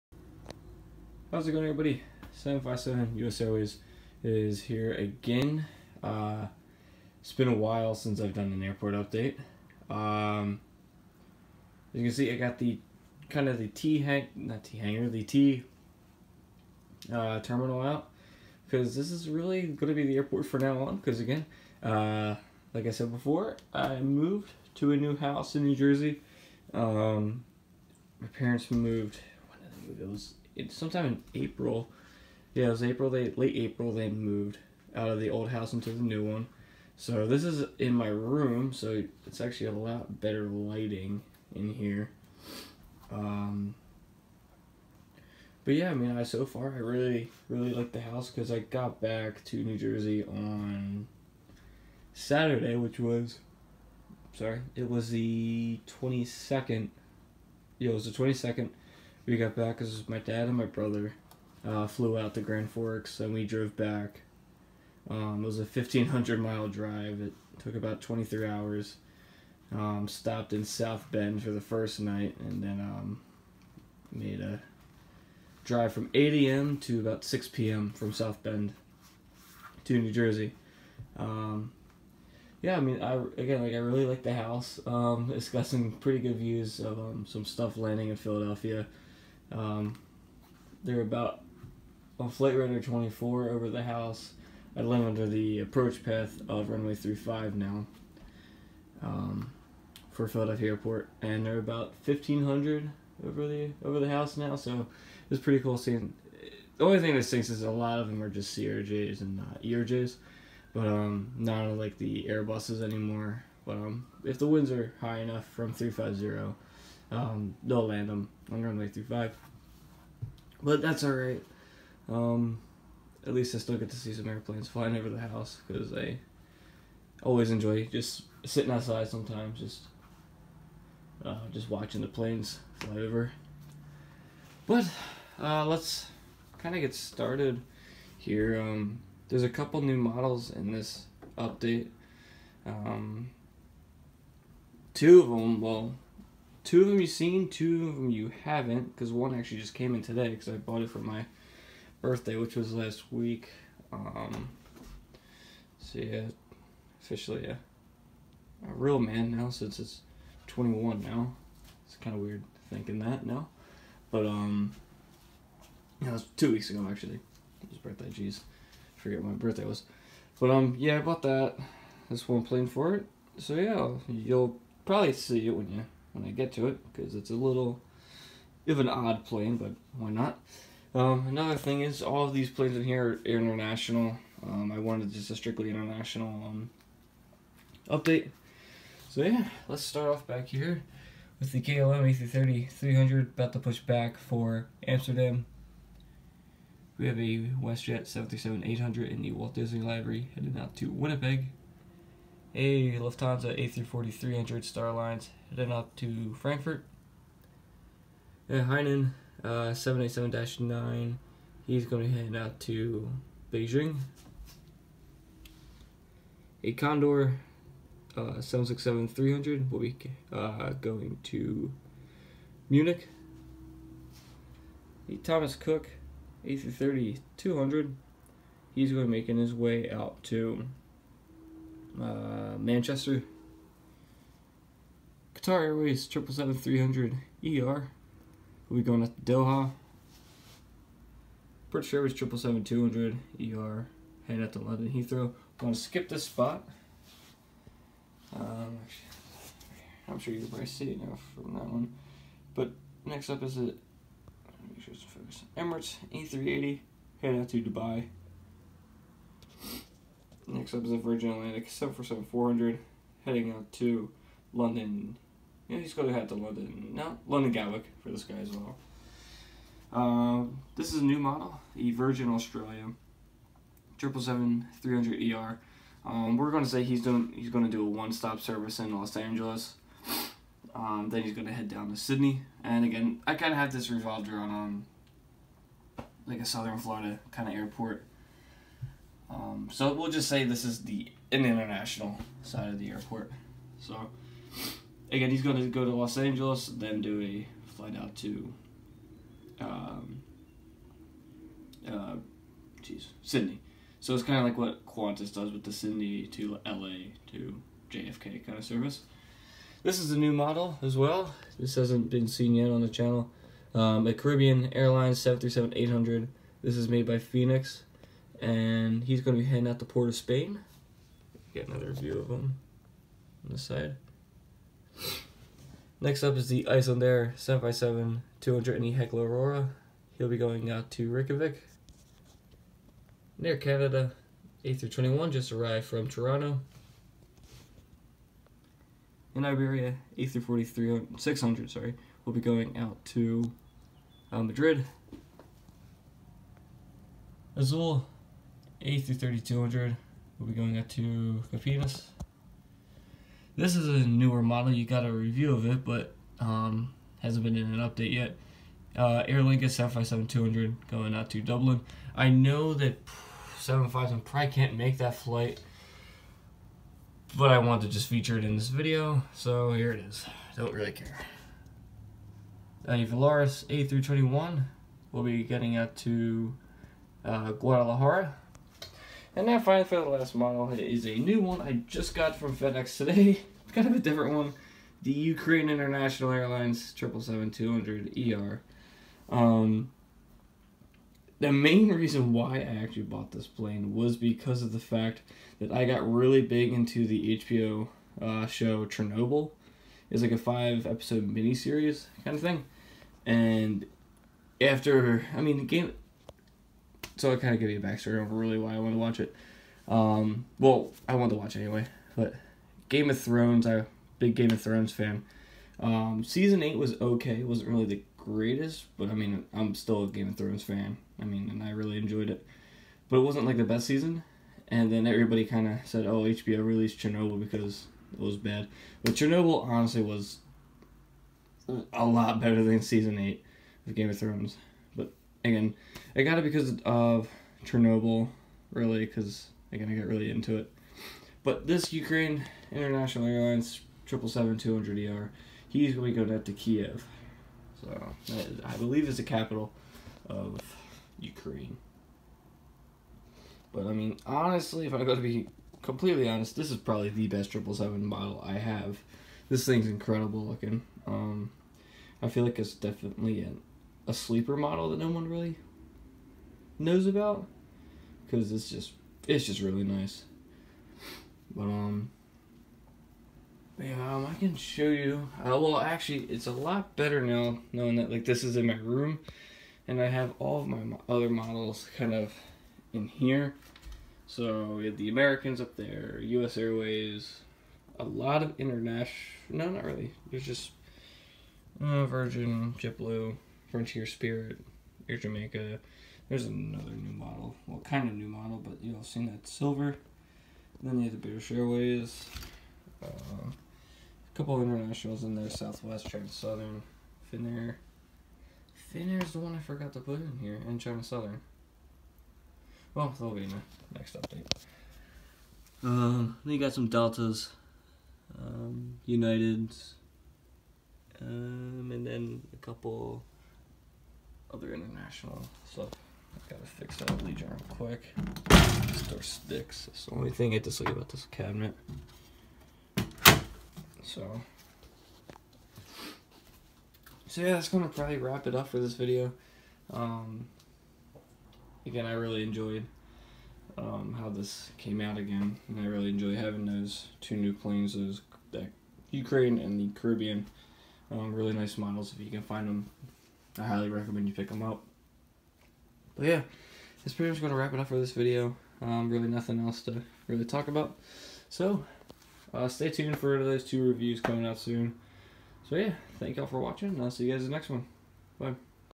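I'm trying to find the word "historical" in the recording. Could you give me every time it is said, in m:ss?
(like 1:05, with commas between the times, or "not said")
not said.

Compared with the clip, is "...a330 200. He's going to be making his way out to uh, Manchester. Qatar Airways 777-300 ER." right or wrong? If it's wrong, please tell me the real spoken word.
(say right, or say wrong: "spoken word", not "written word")
right.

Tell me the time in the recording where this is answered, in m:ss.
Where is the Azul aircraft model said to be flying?
5:51.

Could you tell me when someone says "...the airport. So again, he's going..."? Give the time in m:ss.
4:52.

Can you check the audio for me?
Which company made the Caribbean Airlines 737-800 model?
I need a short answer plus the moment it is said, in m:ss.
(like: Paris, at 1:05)
Phoenix, at 5:17.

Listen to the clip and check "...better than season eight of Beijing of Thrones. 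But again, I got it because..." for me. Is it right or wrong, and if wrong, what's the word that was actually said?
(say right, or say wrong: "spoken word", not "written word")
wrong: "Game", not "Beijing".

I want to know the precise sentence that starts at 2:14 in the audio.
But uh, let's kind of get started here.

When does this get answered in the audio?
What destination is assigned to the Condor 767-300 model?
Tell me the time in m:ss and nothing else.
3:42.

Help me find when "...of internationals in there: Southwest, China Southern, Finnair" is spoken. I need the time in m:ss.
8:24.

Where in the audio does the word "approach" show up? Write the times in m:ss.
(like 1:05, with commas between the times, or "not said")
1:35.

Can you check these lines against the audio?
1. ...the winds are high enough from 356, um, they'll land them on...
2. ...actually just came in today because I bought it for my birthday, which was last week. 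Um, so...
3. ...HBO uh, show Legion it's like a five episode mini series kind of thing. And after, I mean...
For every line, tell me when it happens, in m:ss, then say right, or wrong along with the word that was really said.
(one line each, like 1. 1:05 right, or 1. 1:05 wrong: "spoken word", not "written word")
1. 1:54 wrong: "350", not "356"
2. 2:29 right
3. 6:37 wrong: "Chernobyl", not "Legion".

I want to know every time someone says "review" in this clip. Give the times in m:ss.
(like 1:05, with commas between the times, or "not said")
5:55, 9:23.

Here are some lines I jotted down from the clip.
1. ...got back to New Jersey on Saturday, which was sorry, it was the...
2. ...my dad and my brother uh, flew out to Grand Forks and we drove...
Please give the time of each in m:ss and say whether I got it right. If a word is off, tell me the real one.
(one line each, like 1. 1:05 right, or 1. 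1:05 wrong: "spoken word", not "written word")
1. 0:48 right
2. 1:00 right.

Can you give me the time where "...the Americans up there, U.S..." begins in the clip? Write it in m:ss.
8:04.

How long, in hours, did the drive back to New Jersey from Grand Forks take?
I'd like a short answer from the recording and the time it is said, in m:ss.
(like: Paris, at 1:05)
23, at 1:08.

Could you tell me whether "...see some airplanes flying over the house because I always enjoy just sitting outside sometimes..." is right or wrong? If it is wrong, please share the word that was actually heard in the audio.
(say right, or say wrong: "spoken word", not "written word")
right.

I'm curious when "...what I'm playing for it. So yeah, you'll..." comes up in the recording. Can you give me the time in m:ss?
2:52.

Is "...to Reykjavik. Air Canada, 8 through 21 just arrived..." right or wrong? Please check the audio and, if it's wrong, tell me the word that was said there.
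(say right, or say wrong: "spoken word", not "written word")
right.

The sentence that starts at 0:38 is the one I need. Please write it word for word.
So it's actually a lot better lighting in here.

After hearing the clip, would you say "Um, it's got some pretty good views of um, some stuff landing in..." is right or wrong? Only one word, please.
right.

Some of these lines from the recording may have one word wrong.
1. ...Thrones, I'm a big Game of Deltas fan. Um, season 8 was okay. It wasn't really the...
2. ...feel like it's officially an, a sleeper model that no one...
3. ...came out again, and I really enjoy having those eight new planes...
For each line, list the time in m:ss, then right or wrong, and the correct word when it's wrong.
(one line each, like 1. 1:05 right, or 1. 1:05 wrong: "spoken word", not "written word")
1. 6:53 wrong: "Thrones", not "Deltas"
2. 7:42 wrong: "definitely", not "officially"
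3. 9:04 wrong: "two", not "eight".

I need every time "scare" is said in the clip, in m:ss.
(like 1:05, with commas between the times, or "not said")
not said.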